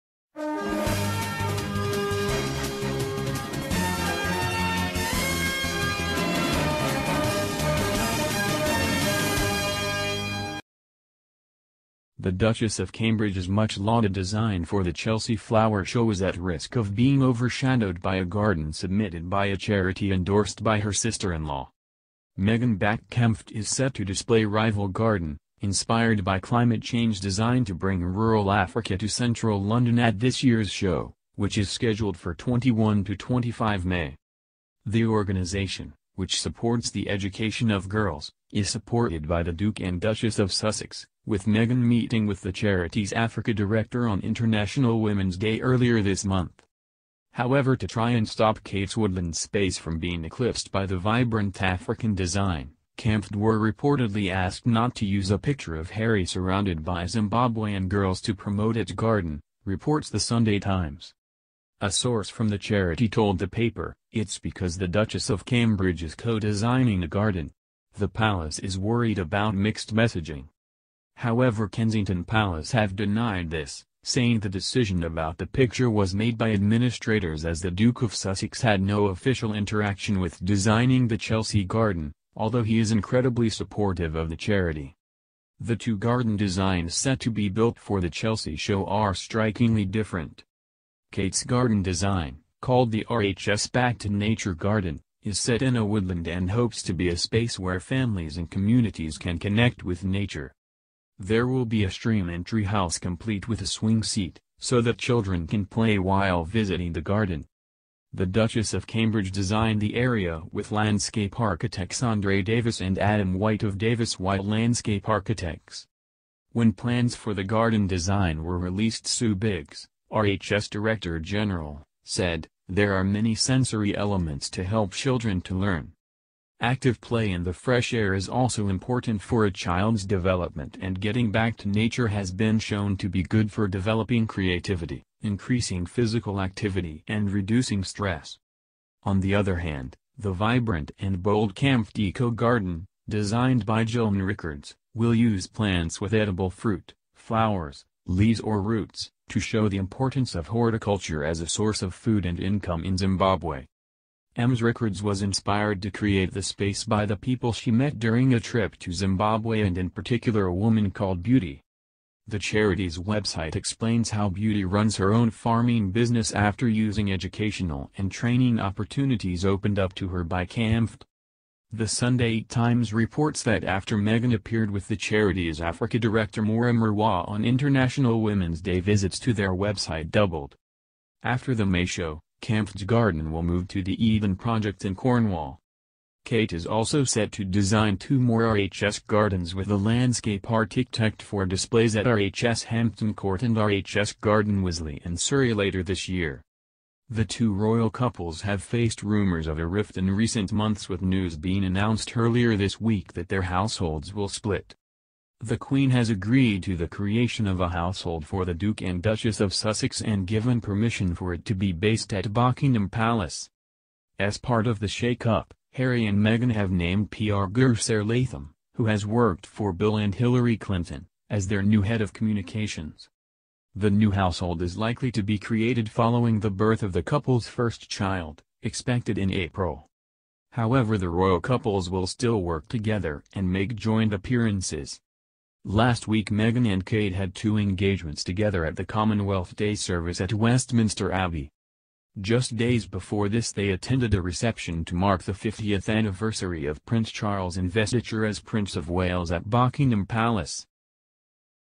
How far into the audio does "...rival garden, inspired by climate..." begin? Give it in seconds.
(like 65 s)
24 s.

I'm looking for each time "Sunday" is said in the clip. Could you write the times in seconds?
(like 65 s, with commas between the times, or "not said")
60 s, 171 s.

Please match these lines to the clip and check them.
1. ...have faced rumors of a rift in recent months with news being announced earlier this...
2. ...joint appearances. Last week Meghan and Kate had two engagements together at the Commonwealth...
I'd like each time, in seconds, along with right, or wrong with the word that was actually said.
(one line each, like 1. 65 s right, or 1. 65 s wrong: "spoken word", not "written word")
1. 198 s right
2. 233 s right.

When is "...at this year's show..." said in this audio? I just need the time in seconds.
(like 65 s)
29 s.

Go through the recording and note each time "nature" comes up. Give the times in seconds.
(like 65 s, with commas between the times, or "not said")
94 s, 100 s, 131 s.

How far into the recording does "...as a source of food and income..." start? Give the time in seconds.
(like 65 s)
151 s.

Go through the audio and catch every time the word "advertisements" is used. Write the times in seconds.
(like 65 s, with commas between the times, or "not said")
not said.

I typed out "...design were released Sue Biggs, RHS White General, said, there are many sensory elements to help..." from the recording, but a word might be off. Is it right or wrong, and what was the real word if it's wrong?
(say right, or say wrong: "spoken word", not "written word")
wrong: "Director", not "White".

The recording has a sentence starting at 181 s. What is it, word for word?
After the May show, Camfed's garden will move to the Eden project in Cornwall.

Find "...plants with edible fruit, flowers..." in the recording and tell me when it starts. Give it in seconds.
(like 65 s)
145 s.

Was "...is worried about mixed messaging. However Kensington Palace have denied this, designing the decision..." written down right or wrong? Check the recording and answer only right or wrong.
wrong.